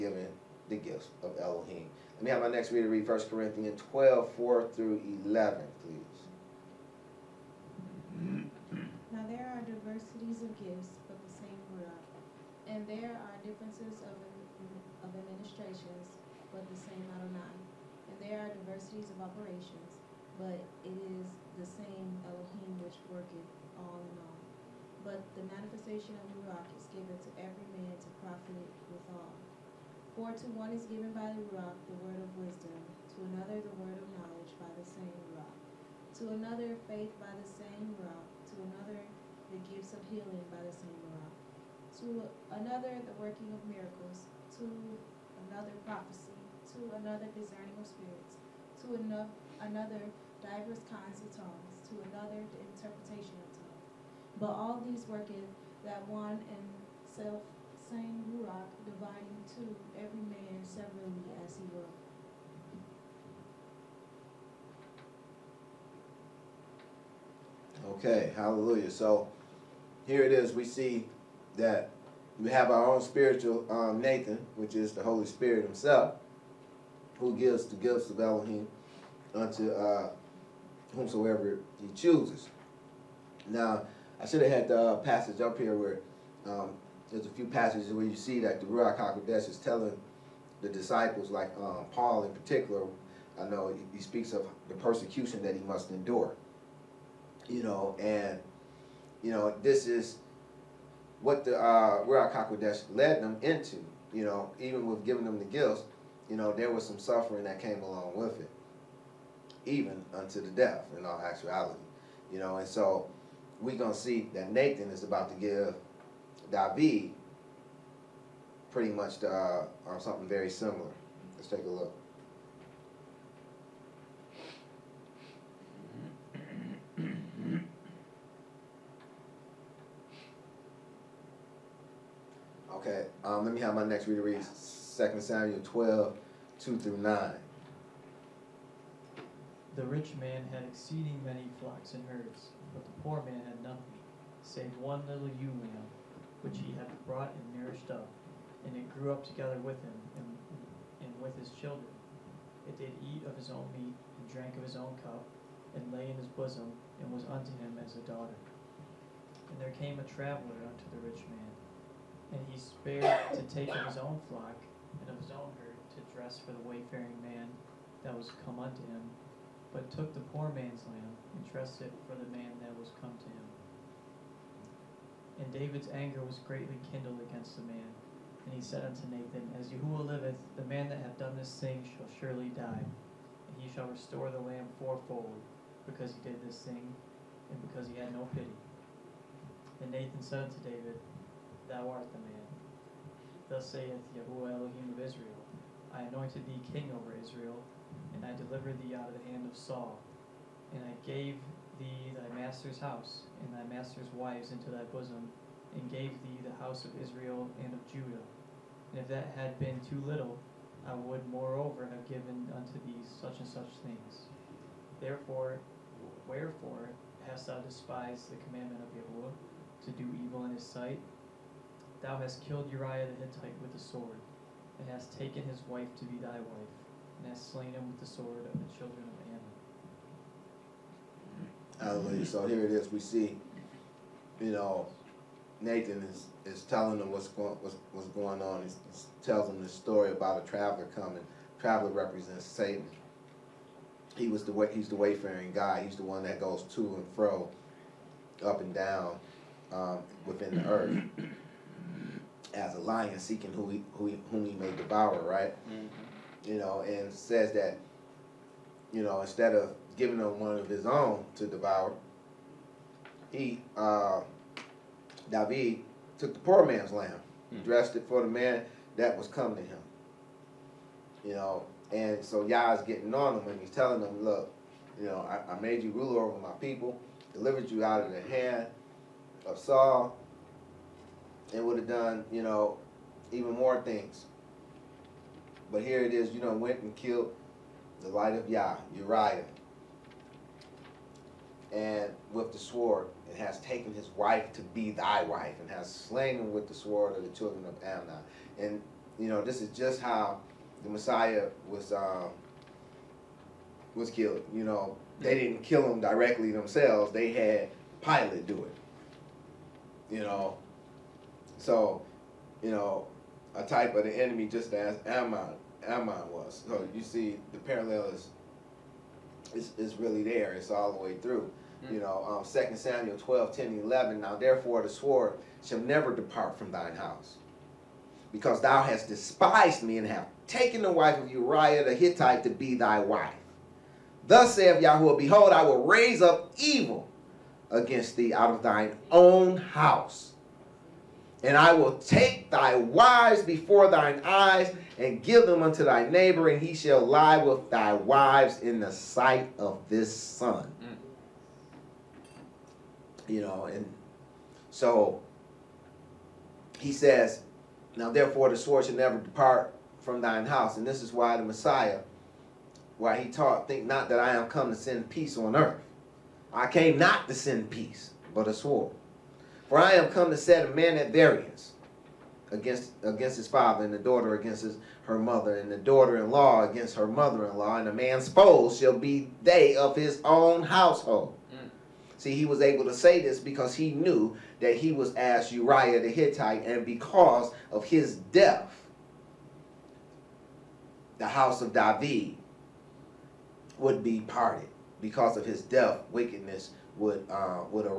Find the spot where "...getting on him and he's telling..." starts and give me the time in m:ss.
4:32.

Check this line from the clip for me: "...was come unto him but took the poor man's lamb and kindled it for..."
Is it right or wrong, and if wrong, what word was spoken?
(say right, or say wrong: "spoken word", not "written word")
wrong: "trusted", not "kindled".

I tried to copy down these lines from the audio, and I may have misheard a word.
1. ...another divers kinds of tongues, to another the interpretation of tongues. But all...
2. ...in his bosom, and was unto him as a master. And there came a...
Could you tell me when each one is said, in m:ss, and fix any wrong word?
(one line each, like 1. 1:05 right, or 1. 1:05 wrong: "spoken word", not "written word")
1. 0:48 right
2. 2:36 wrong: "daughter", not "master".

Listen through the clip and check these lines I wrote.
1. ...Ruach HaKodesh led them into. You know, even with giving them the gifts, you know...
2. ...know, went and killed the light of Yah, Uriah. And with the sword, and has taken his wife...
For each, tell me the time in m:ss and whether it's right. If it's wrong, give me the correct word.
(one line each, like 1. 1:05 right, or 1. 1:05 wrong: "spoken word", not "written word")
1. 1:42 right
2. 4:46 right.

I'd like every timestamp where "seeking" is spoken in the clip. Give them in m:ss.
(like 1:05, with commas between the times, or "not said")
4:13.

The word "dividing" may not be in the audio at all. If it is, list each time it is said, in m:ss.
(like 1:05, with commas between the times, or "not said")
0:58.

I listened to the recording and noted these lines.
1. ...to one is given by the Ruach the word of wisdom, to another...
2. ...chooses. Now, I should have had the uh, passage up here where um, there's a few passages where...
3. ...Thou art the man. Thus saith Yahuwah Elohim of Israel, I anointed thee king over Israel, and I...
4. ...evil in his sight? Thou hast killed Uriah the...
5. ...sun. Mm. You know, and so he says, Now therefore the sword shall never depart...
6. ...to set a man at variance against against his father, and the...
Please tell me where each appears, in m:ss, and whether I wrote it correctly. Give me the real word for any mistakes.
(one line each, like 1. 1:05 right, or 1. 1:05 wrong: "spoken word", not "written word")
1. 0:30 right
2. 1:21 right
3. 3:11 right
4. 3:40 right
5. 5:50 right
6. 6:10 right.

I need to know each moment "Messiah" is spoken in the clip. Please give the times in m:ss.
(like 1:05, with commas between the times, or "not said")
5:00, 6:01.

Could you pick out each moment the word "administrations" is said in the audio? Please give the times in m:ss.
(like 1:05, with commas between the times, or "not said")
0:15.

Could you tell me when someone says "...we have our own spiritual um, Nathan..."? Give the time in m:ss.
1:12.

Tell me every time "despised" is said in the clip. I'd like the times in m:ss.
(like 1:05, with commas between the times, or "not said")
3:37, 5:29.